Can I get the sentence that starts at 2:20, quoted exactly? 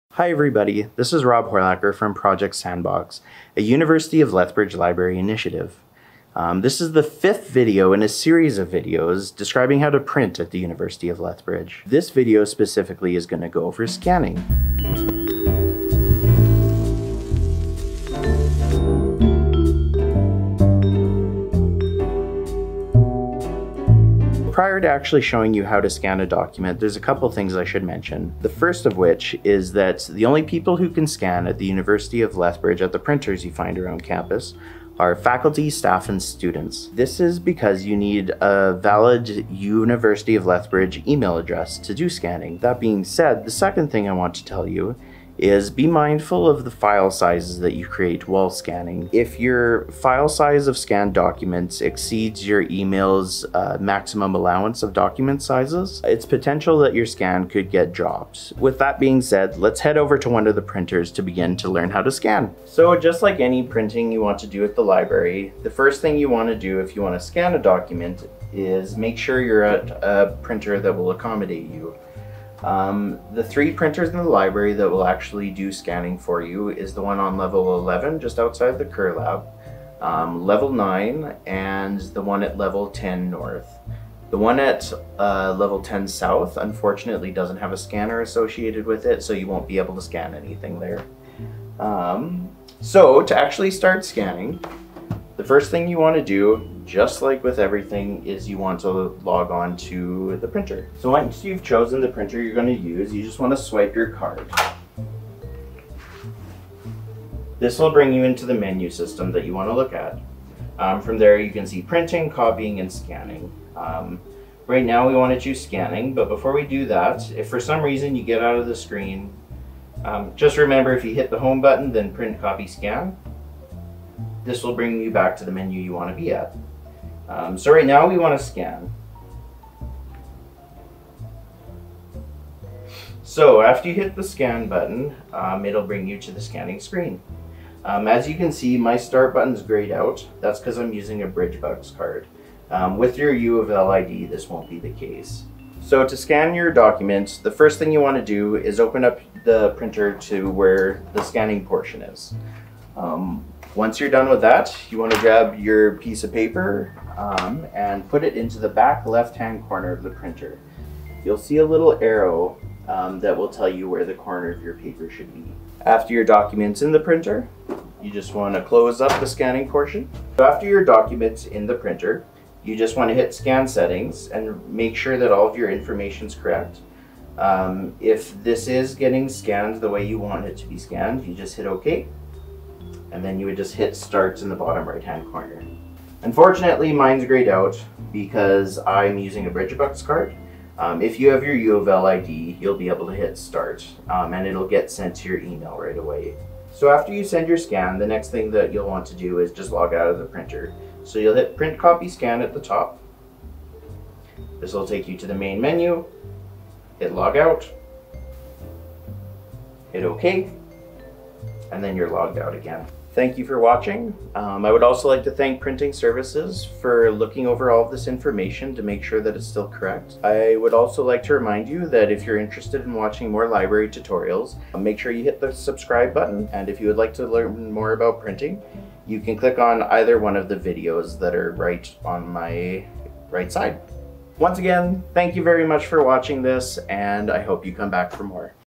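That's because I'm using a BridgeBucks card.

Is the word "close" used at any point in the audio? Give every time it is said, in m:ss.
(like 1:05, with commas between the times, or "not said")
2:48.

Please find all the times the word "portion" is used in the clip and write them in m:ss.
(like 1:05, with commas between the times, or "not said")
2:31, 2:49.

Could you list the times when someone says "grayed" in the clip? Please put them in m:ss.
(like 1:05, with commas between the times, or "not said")
2:19, 3:07.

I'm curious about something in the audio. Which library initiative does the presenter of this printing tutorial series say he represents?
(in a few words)
Project Sandbox.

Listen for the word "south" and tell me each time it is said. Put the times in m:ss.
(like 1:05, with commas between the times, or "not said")
1:26.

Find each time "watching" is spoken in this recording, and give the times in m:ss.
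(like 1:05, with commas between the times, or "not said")
3:33, 3:42, 3:56.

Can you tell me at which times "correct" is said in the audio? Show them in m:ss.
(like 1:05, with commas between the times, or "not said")
2:56, 3:39.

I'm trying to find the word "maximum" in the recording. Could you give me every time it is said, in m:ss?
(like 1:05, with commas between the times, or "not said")
0:53.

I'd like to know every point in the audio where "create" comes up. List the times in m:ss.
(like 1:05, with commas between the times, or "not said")
0:47.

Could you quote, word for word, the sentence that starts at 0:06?
Um, this is the fifth video in a series of videos describing how to print at the University of Lethbridge.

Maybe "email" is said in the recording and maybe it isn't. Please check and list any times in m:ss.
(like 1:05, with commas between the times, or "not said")
0:41, 0:52, 3:15.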